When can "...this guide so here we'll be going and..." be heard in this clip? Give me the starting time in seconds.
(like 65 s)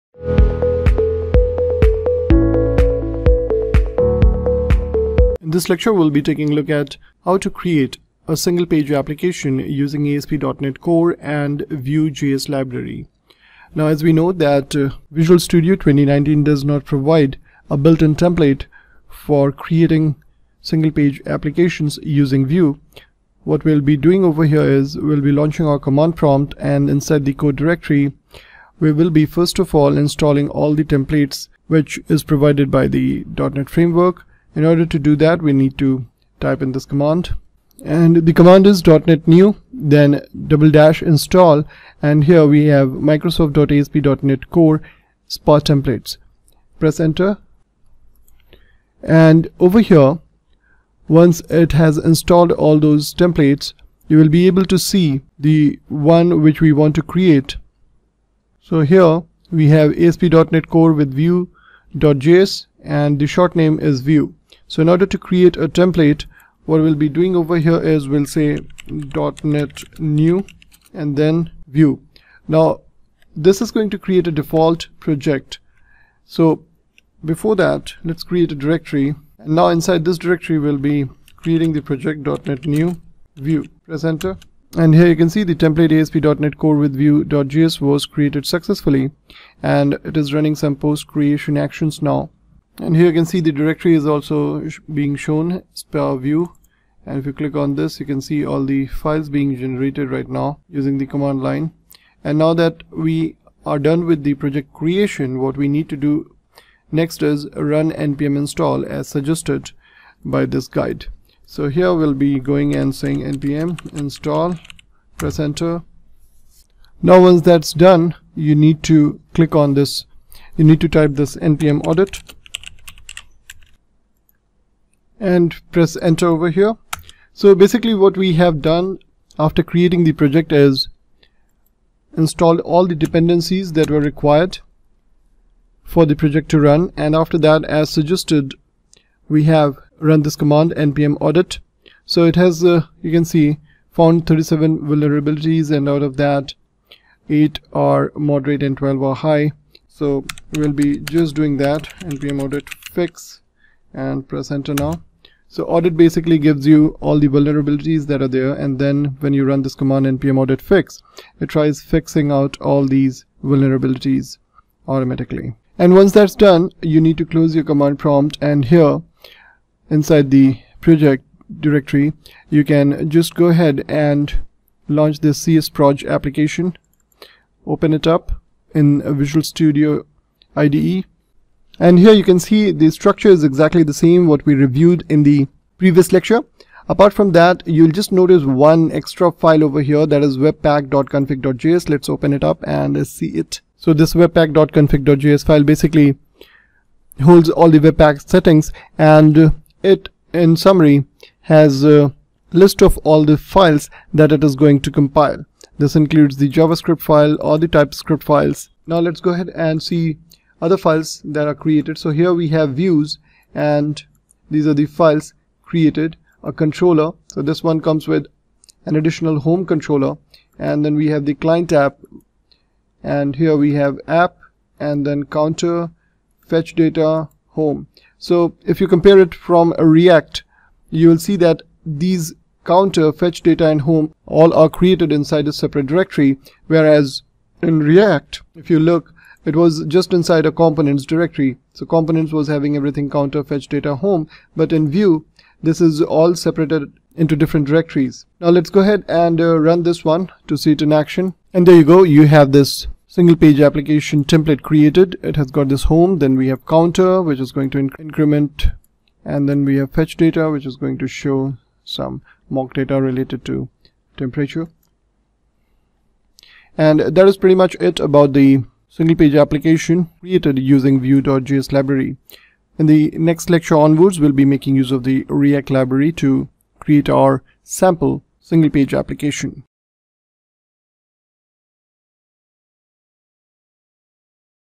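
110 s.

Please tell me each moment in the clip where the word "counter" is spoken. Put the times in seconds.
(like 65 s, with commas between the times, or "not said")
225 s, 232 s, 243 s, 256 s.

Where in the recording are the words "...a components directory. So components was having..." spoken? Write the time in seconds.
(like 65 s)
240 s.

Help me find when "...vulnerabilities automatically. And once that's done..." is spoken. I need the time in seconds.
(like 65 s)
163 s.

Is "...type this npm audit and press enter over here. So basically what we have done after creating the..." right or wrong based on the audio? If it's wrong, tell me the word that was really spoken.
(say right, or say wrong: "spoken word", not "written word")
right.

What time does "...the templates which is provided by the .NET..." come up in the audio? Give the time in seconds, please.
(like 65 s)
30 s.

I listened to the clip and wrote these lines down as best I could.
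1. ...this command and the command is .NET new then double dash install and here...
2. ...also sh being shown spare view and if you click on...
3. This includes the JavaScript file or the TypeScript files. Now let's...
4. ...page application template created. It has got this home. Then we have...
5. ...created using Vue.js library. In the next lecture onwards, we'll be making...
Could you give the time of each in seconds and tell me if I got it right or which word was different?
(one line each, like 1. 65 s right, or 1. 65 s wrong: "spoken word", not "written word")
1. 36 s right
2. 94 s right
3. 205 s right
4. 253 s right
5. 270 s right.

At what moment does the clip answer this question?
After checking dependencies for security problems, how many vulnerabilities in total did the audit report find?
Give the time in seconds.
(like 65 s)
143 s.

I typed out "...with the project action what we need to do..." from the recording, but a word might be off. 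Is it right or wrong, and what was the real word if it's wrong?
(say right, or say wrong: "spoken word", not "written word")
wrong: "creation", not "action".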